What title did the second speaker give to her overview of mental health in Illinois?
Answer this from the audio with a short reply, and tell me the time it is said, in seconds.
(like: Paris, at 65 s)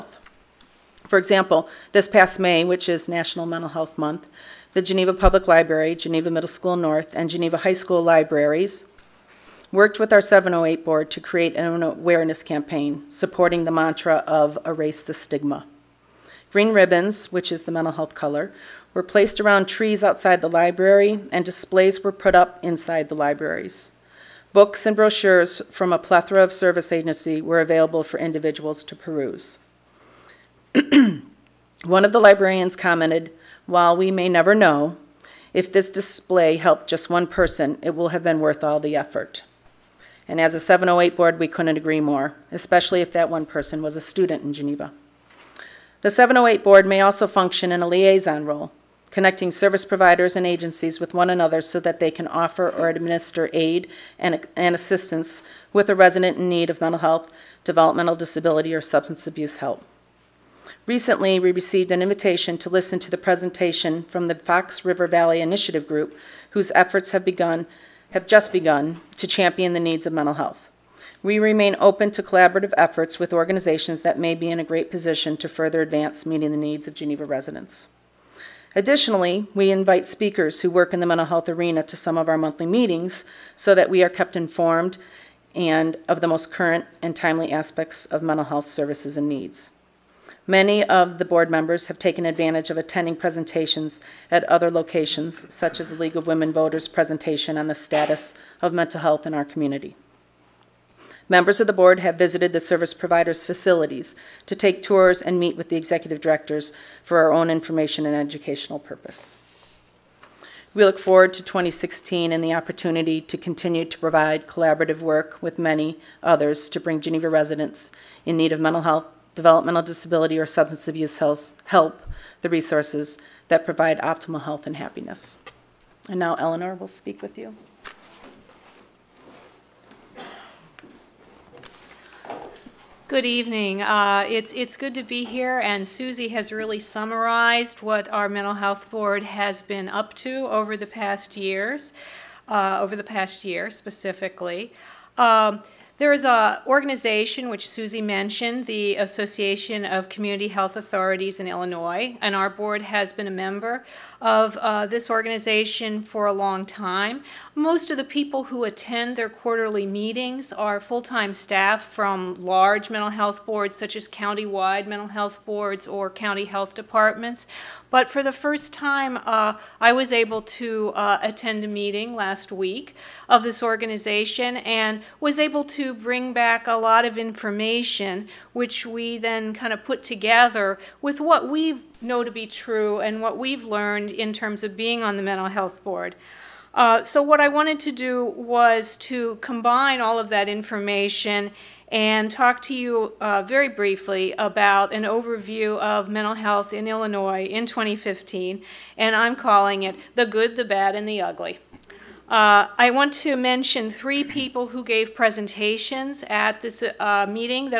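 The Good, the Bad, and the Ugly, at 200 s.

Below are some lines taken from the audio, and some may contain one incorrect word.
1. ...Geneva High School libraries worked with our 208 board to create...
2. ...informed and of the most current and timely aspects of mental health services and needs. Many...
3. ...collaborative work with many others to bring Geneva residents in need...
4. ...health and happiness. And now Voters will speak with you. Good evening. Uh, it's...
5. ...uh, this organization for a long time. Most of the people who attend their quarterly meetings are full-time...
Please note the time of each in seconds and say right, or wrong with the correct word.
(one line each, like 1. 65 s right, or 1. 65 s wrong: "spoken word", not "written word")
1. 7 s wrong: "708", not "208"
2. 84 s right
3. 114 s right
4. 124 s wrong: "Eleanor", not "Voters"
5. 154 s right.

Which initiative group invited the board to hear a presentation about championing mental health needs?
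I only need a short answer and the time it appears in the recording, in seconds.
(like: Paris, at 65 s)
Fox River Valley Initiative Group, at 64 s.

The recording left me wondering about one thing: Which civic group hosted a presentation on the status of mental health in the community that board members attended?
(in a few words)
League of Women Voters.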